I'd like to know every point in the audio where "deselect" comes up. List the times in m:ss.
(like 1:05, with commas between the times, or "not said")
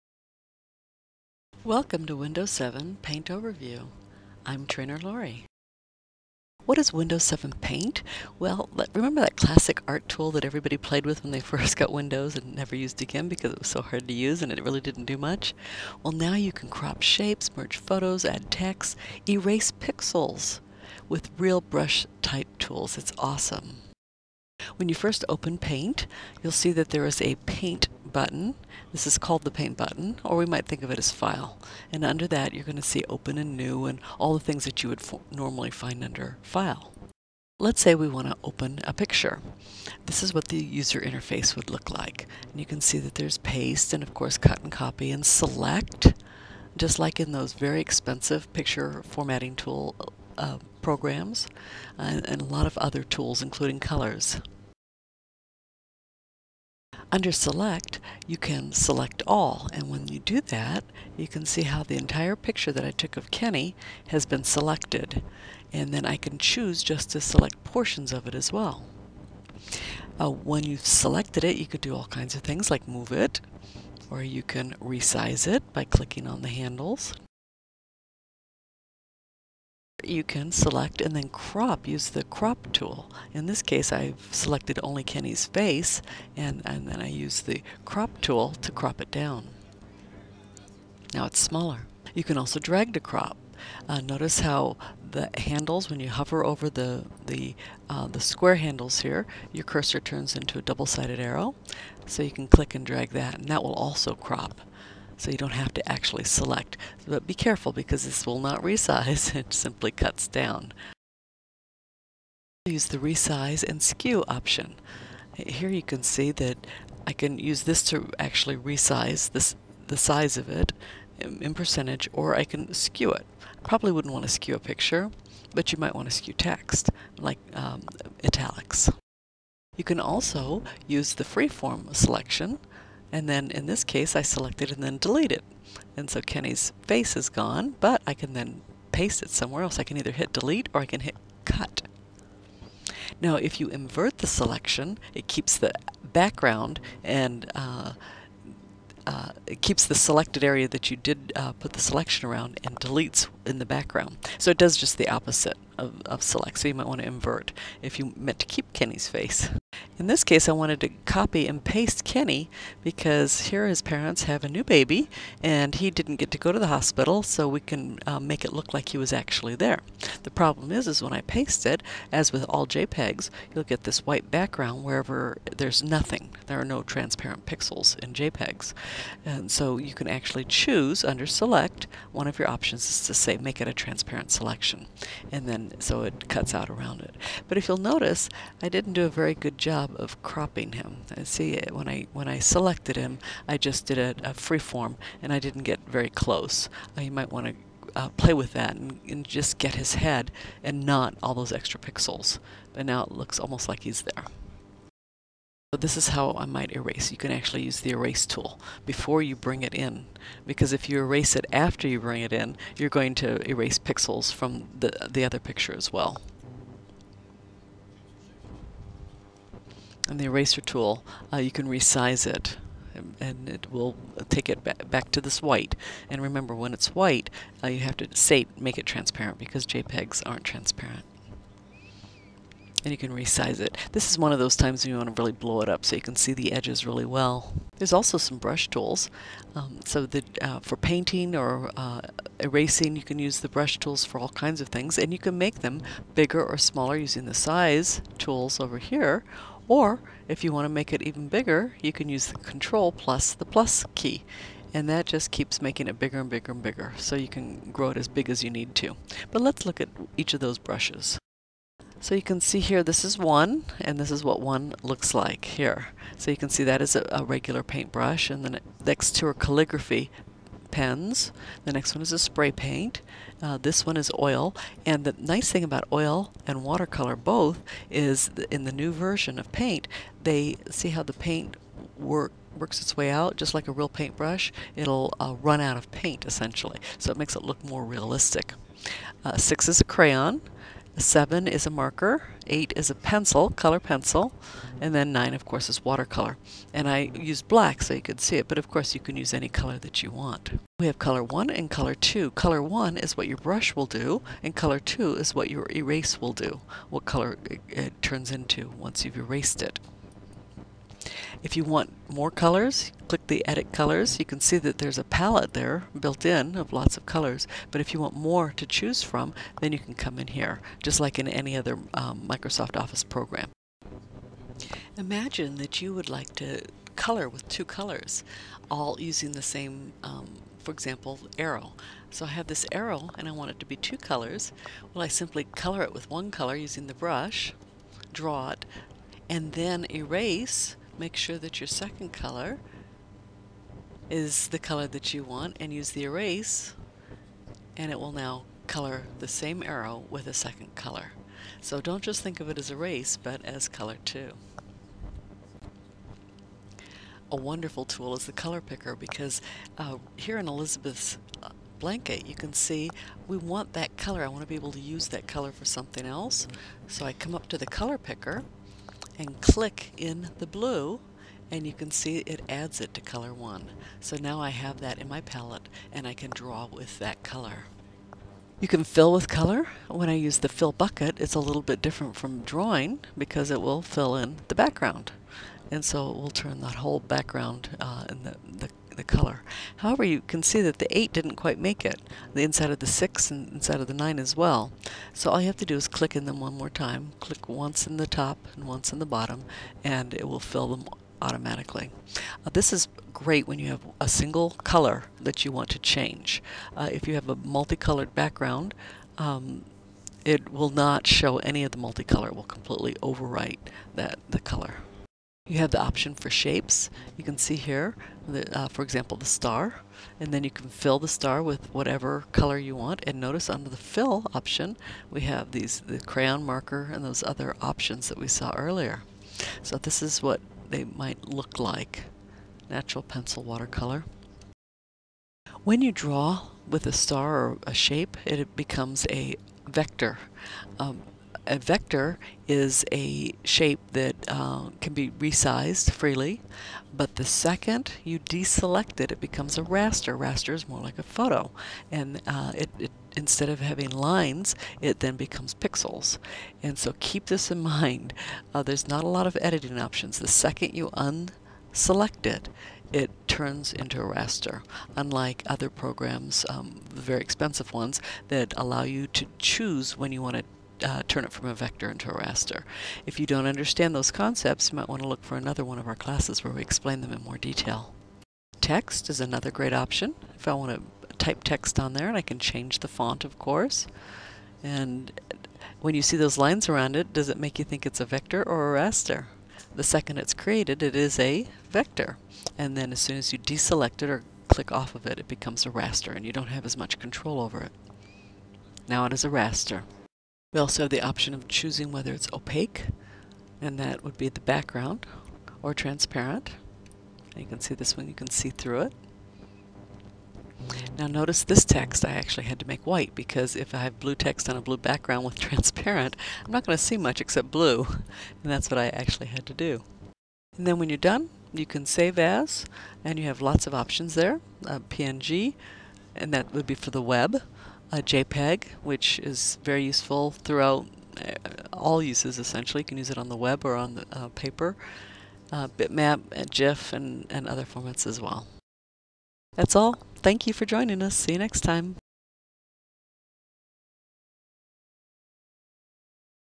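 7:28, 8:13.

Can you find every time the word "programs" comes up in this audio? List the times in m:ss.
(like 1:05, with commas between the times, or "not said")
0:50, 5:23, 7:45.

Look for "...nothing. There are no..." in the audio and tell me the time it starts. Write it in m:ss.
2:55.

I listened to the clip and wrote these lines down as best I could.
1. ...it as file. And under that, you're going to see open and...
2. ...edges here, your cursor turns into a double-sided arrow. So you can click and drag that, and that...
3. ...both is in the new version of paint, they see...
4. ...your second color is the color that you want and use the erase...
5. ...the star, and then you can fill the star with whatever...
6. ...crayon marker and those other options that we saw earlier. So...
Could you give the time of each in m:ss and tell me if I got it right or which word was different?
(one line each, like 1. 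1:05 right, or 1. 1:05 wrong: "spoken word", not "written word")
1. 0:30 right
2. 1:38 wrong: "handles", not "edges"
3. 4:37 right
4. 5:41 right
5. 6:59 right
6. 7:05 right.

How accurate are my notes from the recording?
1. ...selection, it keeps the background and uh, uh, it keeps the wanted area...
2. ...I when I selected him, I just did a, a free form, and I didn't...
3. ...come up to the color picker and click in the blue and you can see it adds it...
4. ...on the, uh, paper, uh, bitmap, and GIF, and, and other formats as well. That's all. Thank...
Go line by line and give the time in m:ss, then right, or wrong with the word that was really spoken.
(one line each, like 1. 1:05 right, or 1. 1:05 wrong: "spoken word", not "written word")
1. 2:24 wrong: "selected", not "wanted"
2. 3:11 right
3. 6:07 right
4. 8:53 right.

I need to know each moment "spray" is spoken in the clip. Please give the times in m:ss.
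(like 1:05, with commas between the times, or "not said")
4:32.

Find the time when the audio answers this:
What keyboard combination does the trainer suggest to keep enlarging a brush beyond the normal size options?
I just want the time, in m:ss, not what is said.
4:12.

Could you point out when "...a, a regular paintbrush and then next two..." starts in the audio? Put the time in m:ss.
4:26.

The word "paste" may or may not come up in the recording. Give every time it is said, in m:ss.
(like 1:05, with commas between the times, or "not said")
0:43, 2:18, 2:41, 2:51.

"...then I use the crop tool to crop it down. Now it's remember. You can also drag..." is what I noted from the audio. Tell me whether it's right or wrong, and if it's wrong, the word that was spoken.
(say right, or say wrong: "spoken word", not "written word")
wrong: "smaller", not "remember".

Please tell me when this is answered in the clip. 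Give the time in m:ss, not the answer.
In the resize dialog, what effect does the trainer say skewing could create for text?
2:08.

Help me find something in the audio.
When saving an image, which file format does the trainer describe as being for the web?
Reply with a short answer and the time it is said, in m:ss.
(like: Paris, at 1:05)
PNG, at 8:44.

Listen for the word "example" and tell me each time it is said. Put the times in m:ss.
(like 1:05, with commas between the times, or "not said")
5:30, 6:58.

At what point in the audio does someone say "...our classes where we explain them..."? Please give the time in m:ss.
7:55.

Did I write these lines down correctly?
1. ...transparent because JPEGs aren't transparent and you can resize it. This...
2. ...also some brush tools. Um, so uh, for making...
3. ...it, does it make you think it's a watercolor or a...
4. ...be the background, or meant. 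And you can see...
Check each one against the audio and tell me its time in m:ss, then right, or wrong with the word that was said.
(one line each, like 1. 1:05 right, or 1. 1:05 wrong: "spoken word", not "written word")
1. 3:48 right
2. 3:57 wrong: "painting", not "making"
3. 8:06 wrong: "vector", not "watercolor"
4. 8:24 wrong: "transparent", not "meant".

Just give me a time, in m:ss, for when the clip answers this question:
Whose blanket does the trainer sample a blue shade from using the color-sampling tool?
6:00.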